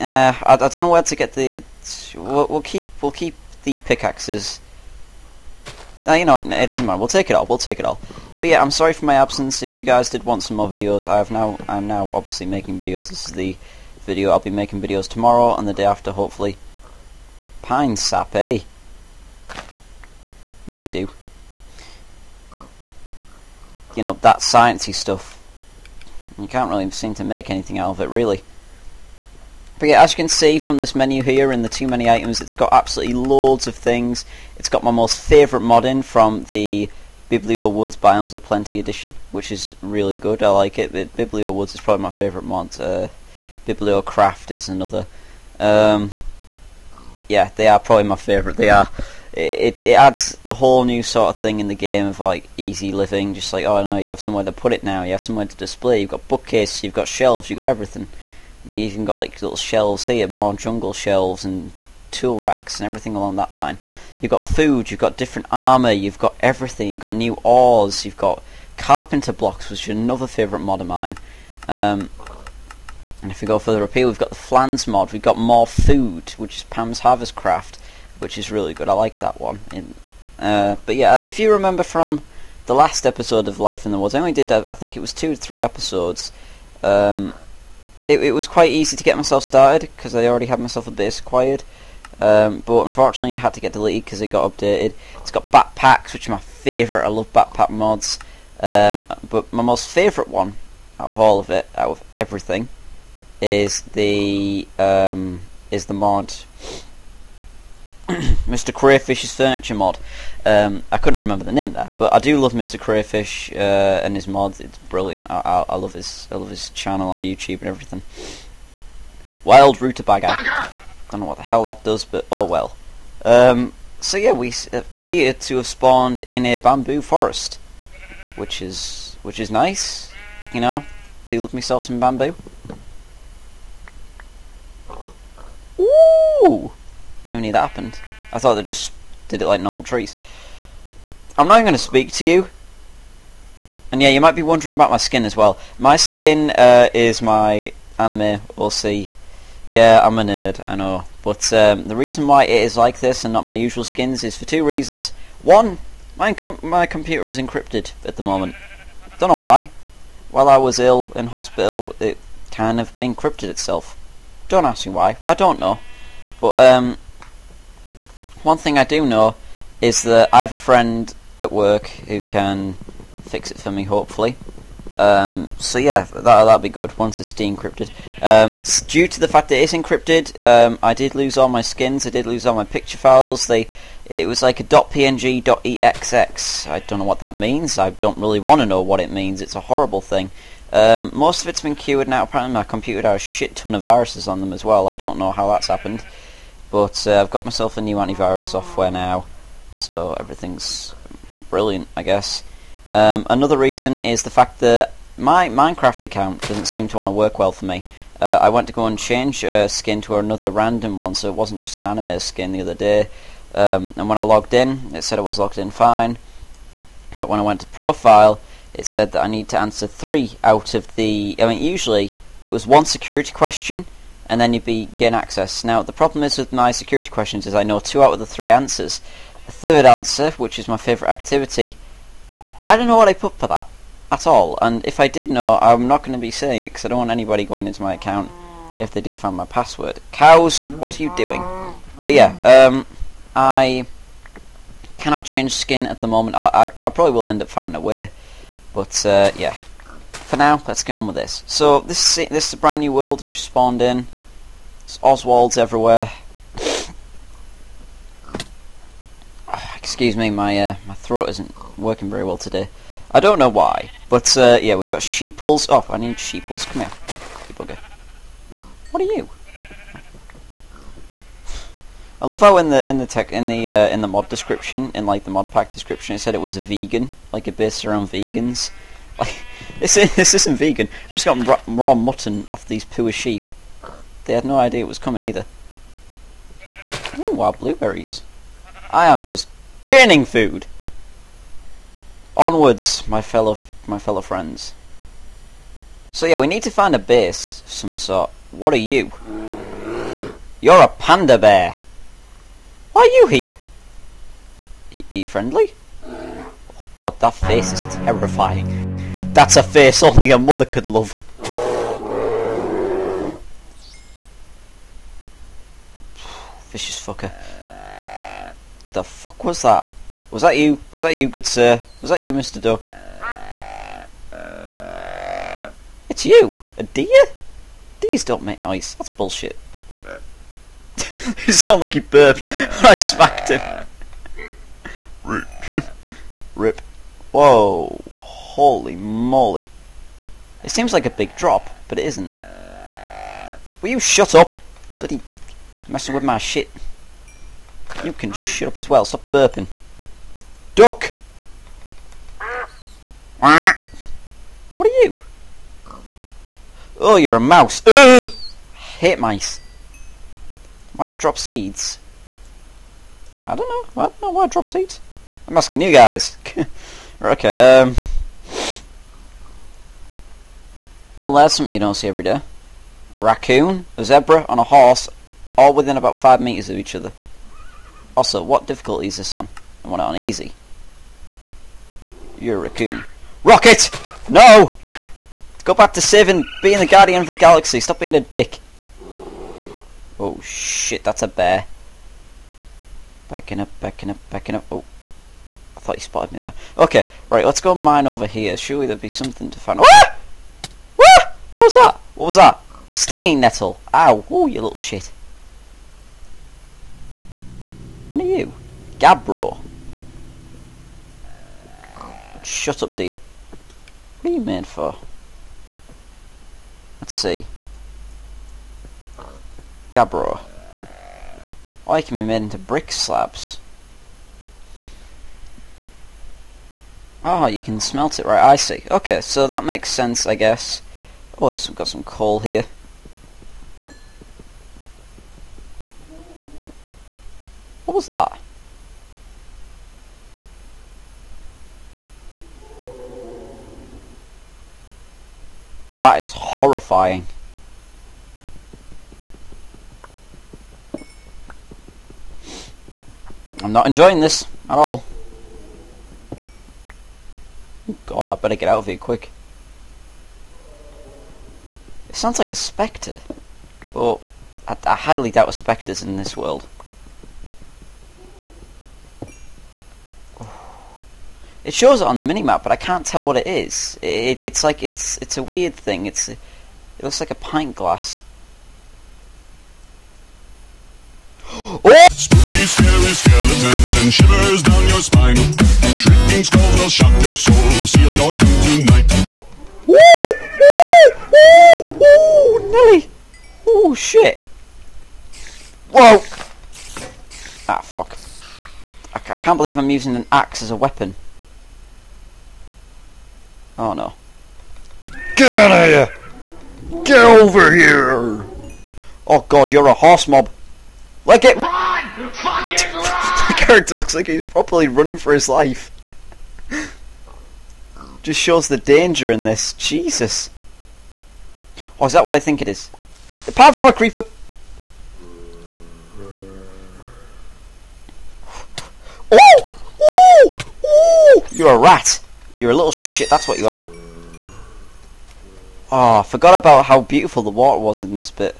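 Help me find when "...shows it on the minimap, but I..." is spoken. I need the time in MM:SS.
07:51.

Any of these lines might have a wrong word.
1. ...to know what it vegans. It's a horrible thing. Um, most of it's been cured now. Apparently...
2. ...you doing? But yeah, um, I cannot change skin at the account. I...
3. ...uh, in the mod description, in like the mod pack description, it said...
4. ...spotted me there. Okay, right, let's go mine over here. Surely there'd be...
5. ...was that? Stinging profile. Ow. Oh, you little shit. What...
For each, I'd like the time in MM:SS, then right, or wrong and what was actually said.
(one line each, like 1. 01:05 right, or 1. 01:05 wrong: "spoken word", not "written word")
1. 03:08 wrong: "means", not "vegans"
2. 04:01 wrong: "moment", not "account"
3. 04:33 right
4. 06:36 right
5. 06:42 wrong: "nettle", not "profile".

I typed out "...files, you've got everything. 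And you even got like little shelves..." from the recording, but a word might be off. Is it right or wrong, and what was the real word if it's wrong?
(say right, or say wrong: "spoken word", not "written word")
wrong: "shelves", not "files".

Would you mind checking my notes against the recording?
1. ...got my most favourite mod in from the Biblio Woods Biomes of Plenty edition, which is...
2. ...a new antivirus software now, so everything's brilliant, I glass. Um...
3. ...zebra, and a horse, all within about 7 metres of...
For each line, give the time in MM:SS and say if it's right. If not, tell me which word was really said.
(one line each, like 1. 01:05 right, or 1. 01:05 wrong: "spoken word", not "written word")
1. 00:34 right
2. 03:17 wrong: "guess", not "glass"
3. 06:14 wrong: "5", not "7".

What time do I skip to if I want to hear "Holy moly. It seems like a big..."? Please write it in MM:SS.
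05:38.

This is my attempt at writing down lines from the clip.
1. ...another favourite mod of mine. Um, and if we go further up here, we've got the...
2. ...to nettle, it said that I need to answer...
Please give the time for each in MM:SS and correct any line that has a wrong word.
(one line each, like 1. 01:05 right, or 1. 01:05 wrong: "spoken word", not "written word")
1. 01:09 right
2. 03:37 wrong: "profile", not "nettle".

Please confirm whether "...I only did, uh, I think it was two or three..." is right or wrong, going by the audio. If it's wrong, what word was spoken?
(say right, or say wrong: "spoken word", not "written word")
right.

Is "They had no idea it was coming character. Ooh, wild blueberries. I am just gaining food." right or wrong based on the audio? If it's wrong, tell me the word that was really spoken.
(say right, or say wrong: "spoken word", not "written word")
wrong: "either", not "character".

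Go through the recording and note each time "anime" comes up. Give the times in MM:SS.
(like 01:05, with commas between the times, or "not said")
02:27, 03:31.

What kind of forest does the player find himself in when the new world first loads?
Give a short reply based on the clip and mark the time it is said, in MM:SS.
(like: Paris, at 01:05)
Bamboo forest, at 02:06.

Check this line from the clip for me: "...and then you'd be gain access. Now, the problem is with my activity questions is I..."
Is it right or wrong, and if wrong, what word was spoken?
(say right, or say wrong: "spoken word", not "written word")
wrong: "security", not "activity".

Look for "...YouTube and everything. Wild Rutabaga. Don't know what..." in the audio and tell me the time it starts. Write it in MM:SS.
01:57.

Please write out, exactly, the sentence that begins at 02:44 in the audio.
Don't ask me why, I don't know.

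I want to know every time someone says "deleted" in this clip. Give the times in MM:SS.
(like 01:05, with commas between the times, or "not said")
01:33.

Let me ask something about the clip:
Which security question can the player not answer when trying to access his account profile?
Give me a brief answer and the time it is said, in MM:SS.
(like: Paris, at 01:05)
Favourite activity, at 03:50.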